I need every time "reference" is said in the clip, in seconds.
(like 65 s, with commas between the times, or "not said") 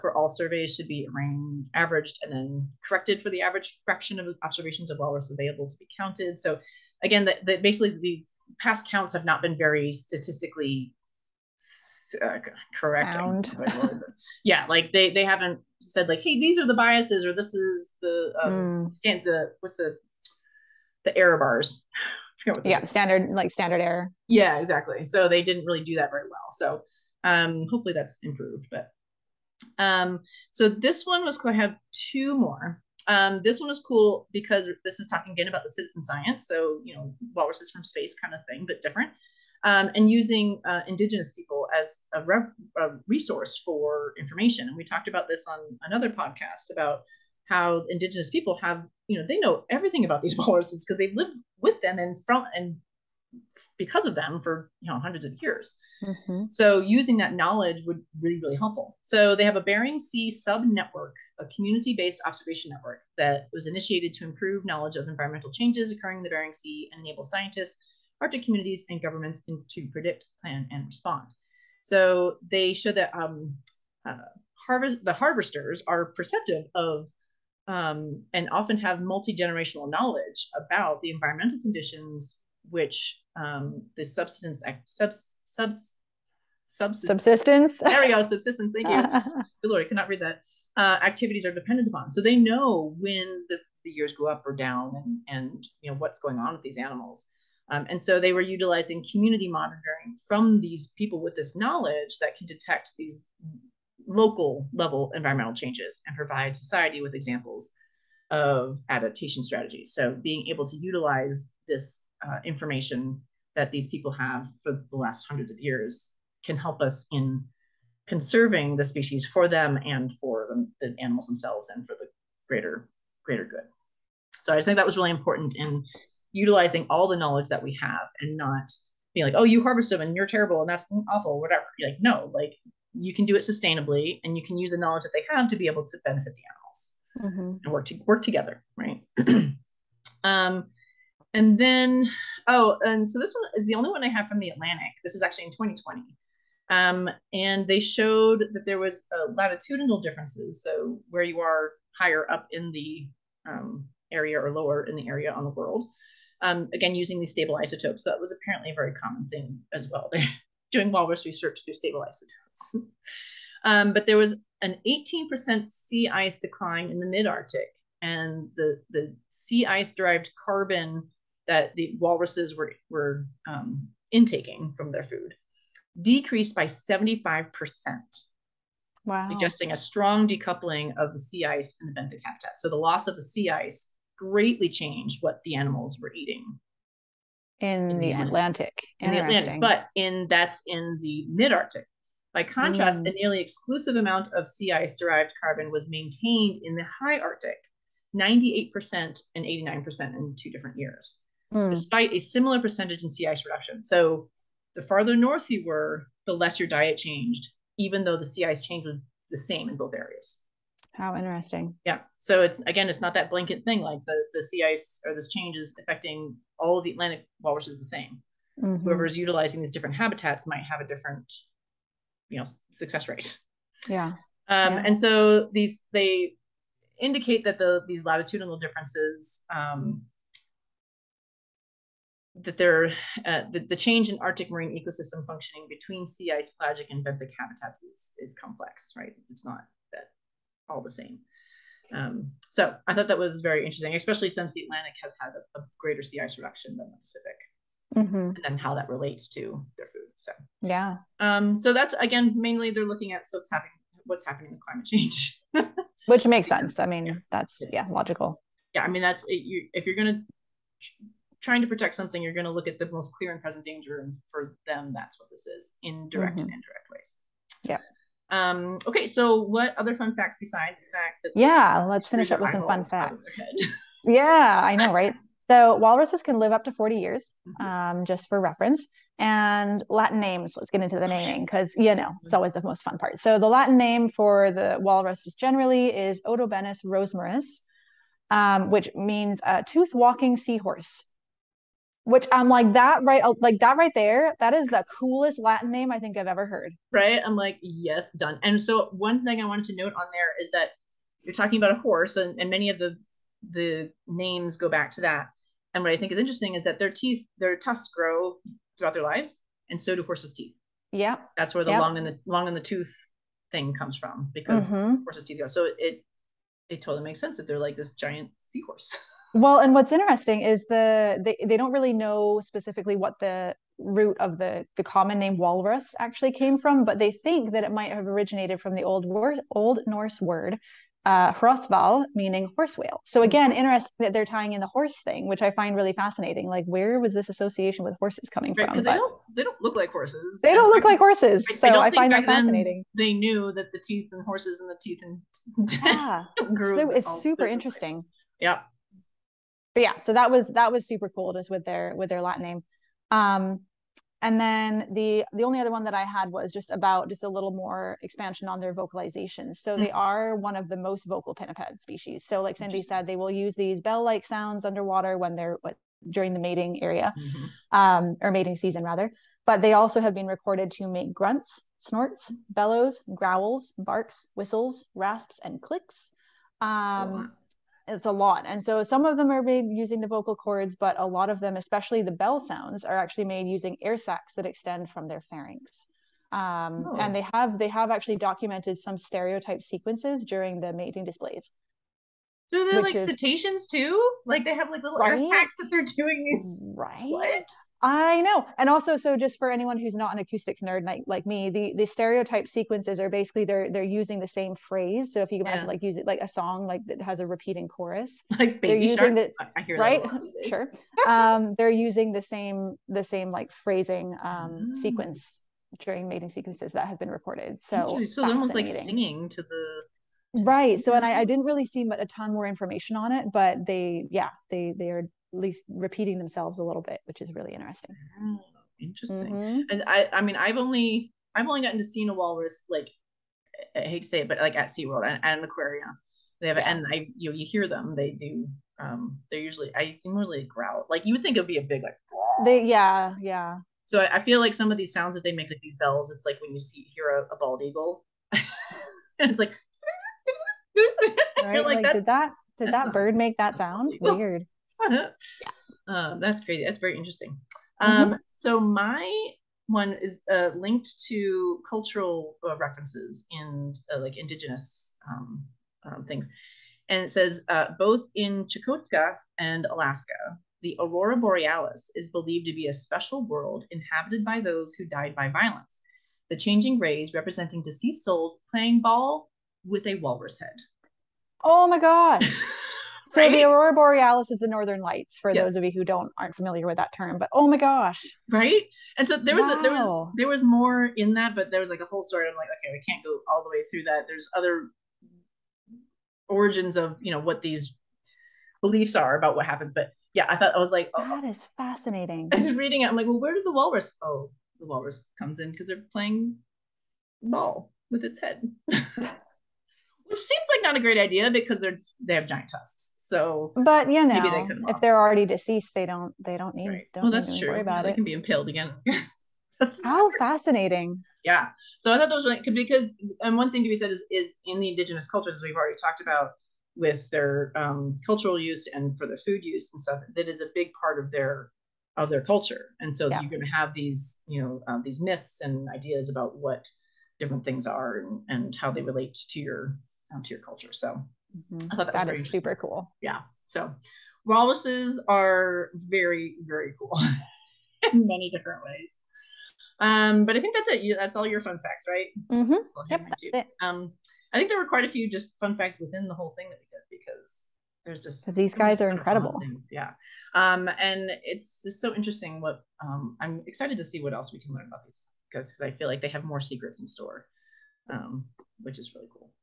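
278 s, 462 s.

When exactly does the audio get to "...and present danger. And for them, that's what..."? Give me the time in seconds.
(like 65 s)
263 s.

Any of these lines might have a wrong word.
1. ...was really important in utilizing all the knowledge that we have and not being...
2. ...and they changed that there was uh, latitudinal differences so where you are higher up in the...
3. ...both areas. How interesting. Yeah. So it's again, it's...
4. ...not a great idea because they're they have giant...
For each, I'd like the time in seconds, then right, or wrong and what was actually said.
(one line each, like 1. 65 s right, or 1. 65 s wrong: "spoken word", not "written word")
1. 124 s right
2. 147 s wrong: "showed", not "changed"
3. 209 s right
4. 510 s right.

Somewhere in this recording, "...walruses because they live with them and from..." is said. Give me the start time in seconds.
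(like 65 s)
50 s.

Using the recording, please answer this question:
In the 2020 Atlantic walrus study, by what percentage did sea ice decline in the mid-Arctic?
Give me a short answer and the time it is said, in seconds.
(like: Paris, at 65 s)
18%, at 164 s.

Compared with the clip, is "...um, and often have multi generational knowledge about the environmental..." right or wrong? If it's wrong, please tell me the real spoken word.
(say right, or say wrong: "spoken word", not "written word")
right.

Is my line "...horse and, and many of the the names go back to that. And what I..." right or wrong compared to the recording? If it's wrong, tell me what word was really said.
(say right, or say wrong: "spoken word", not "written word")
right.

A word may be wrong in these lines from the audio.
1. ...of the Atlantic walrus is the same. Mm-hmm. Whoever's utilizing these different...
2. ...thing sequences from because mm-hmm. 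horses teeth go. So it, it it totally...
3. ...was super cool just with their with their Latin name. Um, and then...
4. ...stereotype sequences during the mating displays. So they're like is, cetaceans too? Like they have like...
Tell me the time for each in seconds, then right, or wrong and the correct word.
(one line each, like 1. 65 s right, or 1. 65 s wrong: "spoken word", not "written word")
1. 216 s right
2. 313 s wrong: "comes", not "sequences"
3. 350 s right
4. 388 s right.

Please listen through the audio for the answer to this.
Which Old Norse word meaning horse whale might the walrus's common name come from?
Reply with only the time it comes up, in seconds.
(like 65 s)
331 s.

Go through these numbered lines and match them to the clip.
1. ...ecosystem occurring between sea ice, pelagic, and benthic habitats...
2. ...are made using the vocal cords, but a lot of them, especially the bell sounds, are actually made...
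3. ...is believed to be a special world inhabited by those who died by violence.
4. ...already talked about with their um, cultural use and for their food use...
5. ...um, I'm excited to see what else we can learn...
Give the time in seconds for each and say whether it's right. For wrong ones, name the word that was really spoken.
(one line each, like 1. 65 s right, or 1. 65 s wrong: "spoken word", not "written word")
1. 234 s wrong: "functioning", not "occurring"
2. 379 s right
3. 471 s right
4. 525 s right
5. 562 s right.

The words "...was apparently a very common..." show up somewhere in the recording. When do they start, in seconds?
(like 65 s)
158 s.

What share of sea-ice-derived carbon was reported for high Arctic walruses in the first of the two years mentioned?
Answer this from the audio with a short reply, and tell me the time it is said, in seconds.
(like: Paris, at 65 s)
98%, at 198 s.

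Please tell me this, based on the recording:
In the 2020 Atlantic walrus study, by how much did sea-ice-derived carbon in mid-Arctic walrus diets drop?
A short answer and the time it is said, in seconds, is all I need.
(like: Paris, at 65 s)
75%, at 176 s.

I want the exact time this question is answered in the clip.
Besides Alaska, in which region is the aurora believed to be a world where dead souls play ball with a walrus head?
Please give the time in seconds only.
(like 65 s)
468 s.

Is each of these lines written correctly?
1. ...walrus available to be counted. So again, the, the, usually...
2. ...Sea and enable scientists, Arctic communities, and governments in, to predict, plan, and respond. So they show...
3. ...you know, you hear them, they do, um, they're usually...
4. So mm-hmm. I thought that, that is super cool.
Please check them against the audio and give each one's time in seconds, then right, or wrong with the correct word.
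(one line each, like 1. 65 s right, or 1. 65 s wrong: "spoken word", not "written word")
1. 4 s wrong: "basically", not "usually"
2. 66 s right
3. 437 s right
4. 540 s right.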